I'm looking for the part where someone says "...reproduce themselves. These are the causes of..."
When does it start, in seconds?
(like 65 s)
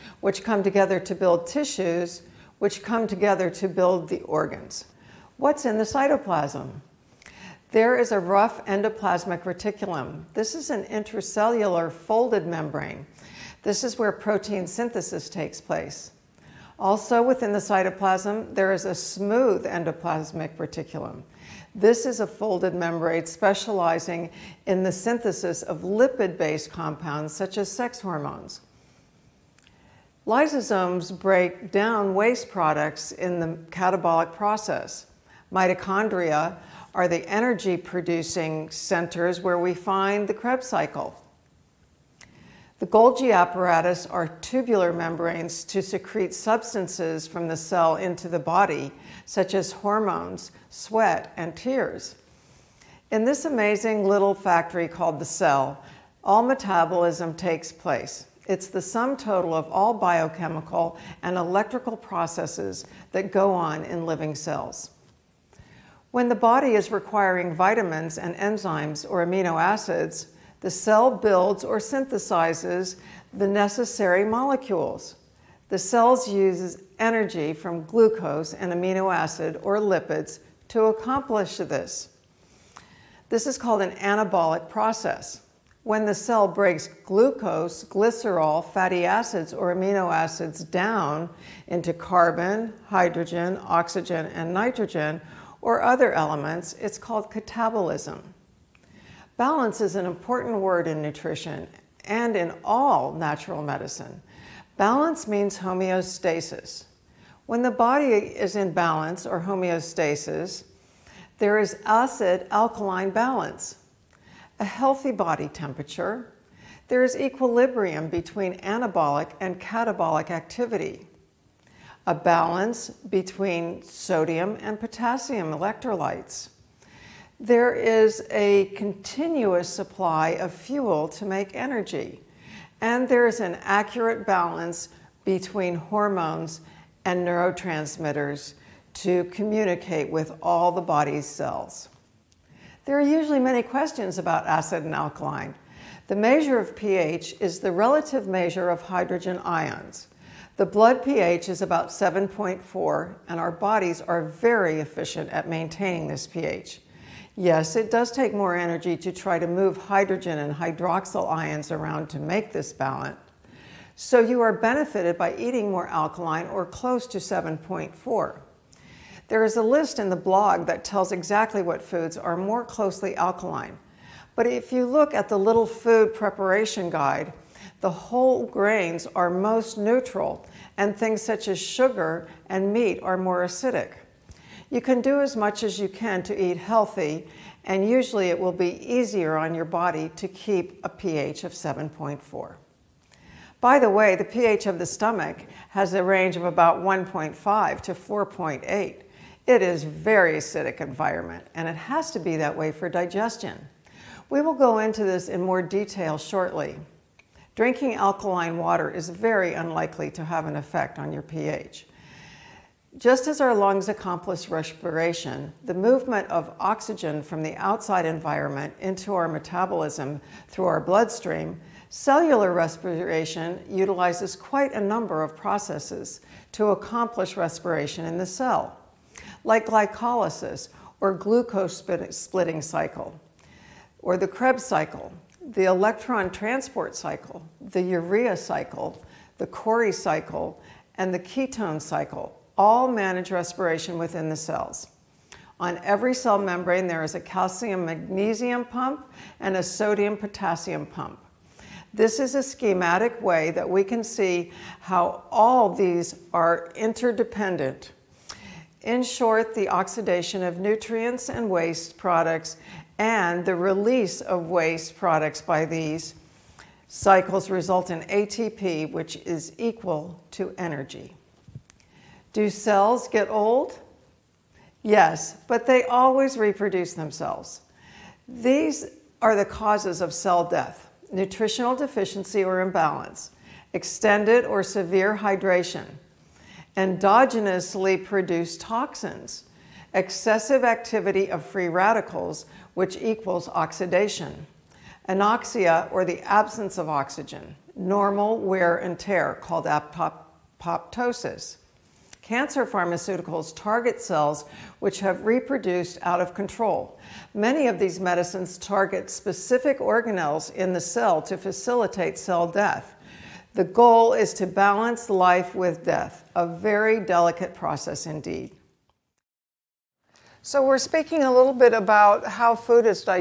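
276 s.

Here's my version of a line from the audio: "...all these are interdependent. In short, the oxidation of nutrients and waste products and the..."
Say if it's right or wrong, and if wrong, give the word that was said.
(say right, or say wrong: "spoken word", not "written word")
right.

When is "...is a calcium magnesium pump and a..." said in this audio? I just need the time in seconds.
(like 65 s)
247 s.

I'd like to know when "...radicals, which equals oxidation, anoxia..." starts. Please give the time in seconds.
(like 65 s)
291 s.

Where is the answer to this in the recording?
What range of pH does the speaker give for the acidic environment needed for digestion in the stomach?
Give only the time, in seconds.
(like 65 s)
196 s.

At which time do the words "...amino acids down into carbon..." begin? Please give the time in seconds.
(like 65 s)
89 s.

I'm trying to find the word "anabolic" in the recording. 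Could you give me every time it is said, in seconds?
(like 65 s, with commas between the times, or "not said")
83 s, 118 s.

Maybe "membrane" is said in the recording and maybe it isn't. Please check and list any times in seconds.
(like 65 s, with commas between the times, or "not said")
12 s, 22 s, 44 s, 246 s.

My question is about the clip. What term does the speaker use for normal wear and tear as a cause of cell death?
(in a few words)
apoptosis.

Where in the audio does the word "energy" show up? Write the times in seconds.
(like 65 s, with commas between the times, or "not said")
37 s, 76 s, 131 s, 158 s, 270 s.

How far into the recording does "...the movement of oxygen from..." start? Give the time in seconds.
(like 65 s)
215 s.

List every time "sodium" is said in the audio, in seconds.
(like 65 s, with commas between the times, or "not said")
123 s, 249 s.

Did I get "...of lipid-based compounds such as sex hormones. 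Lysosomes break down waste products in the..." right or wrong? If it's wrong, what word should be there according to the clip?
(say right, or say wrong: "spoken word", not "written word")
right.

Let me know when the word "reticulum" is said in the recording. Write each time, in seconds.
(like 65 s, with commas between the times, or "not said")
9 s, 20 s.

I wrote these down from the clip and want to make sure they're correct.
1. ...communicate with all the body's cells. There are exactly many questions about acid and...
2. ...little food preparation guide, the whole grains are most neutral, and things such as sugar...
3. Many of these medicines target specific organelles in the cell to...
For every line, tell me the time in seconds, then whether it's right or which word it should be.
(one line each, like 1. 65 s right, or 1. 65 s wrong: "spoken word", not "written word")
1. 139 s wrong: "usually", not "exactly"
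2. 175 s right
3. 307 s right.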